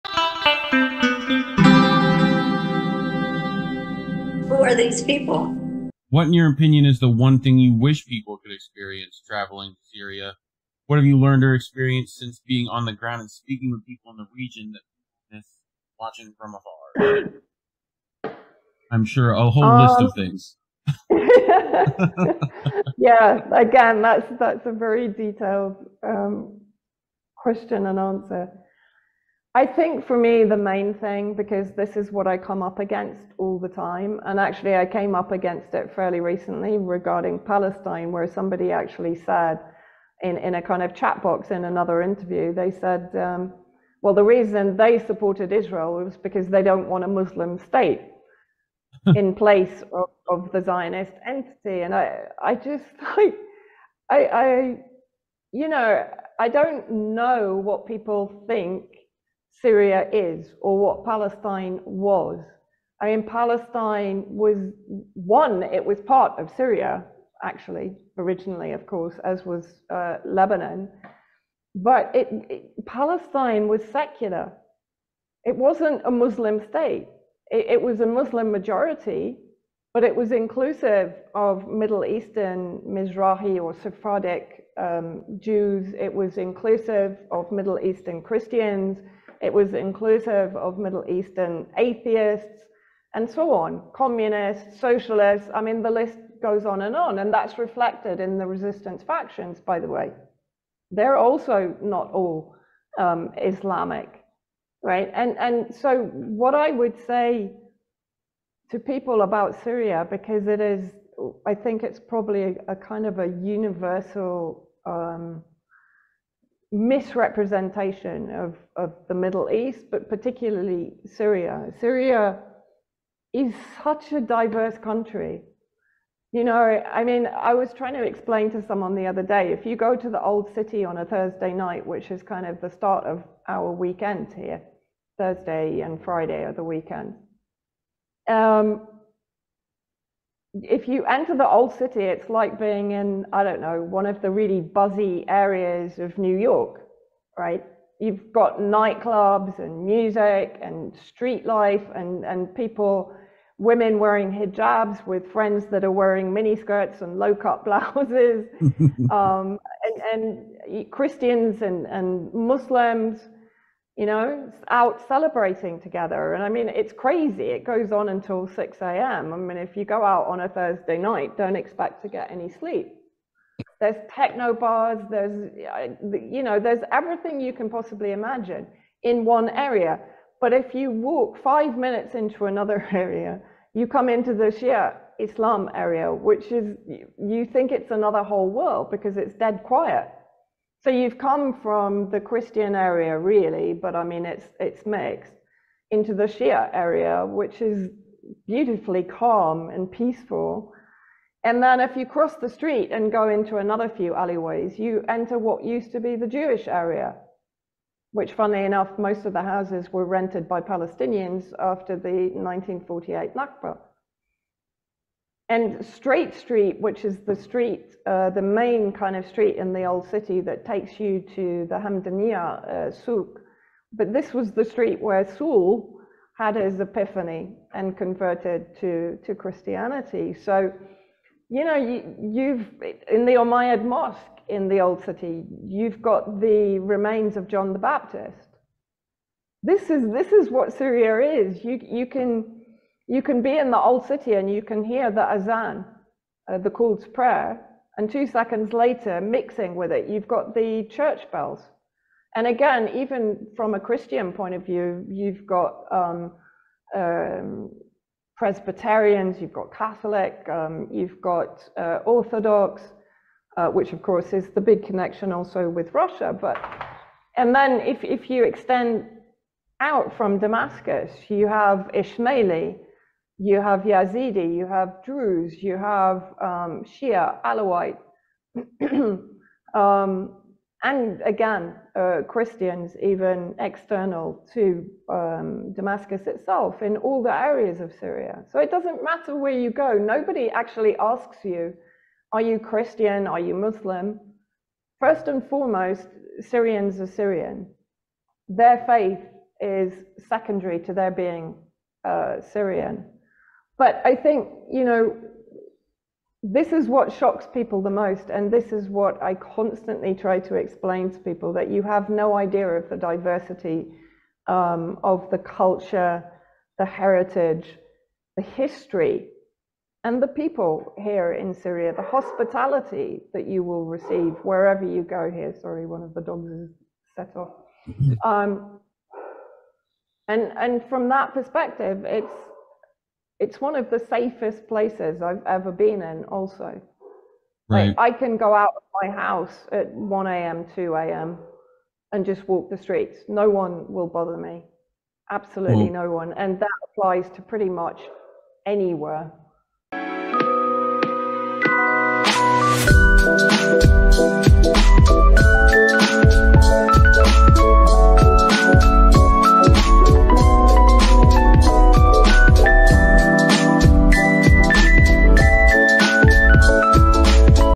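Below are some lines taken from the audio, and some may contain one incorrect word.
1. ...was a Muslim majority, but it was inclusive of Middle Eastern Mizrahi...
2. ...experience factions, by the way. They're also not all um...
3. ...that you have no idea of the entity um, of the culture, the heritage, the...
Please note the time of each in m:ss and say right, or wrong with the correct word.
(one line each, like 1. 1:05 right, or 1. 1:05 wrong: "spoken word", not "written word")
1. 1:17 right
2. 1:38 wrong: "resistance", not "experience"
3. 5:11 wrong: "diversity", not "entity".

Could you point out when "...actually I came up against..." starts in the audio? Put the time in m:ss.
0:34.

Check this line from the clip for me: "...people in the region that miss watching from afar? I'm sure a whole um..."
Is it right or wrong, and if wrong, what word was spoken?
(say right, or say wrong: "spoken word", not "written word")
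right.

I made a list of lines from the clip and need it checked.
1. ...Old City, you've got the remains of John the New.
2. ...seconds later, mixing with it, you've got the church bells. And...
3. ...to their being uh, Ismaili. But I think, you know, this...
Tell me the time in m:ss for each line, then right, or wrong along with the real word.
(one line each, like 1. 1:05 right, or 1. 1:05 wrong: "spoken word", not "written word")
1. 3:54 wrong: "Baptist", not "New"
2. 4:08 right
3. 5:00 wrong: "Syrian", not "Ismaili".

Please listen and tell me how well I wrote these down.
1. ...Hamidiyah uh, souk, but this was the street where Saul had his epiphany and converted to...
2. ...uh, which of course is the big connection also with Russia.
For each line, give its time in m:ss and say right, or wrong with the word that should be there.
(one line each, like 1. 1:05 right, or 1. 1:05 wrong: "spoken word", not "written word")
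1. 3:41 right
2. 4:23 right.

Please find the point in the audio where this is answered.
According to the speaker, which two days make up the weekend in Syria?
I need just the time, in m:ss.
2:15.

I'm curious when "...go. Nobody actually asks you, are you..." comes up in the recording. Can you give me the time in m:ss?
4:49.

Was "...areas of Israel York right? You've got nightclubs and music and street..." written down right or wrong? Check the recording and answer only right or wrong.
wrong.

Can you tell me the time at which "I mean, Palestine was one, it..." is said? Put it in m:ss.
1:03.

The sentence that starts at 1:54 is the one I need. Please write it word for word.
Um, misrepresentation of, of the Middle East, but particularly Syria.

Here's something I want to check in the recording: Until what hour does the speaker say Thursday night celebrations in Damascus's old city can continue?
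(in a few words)
6 a.m.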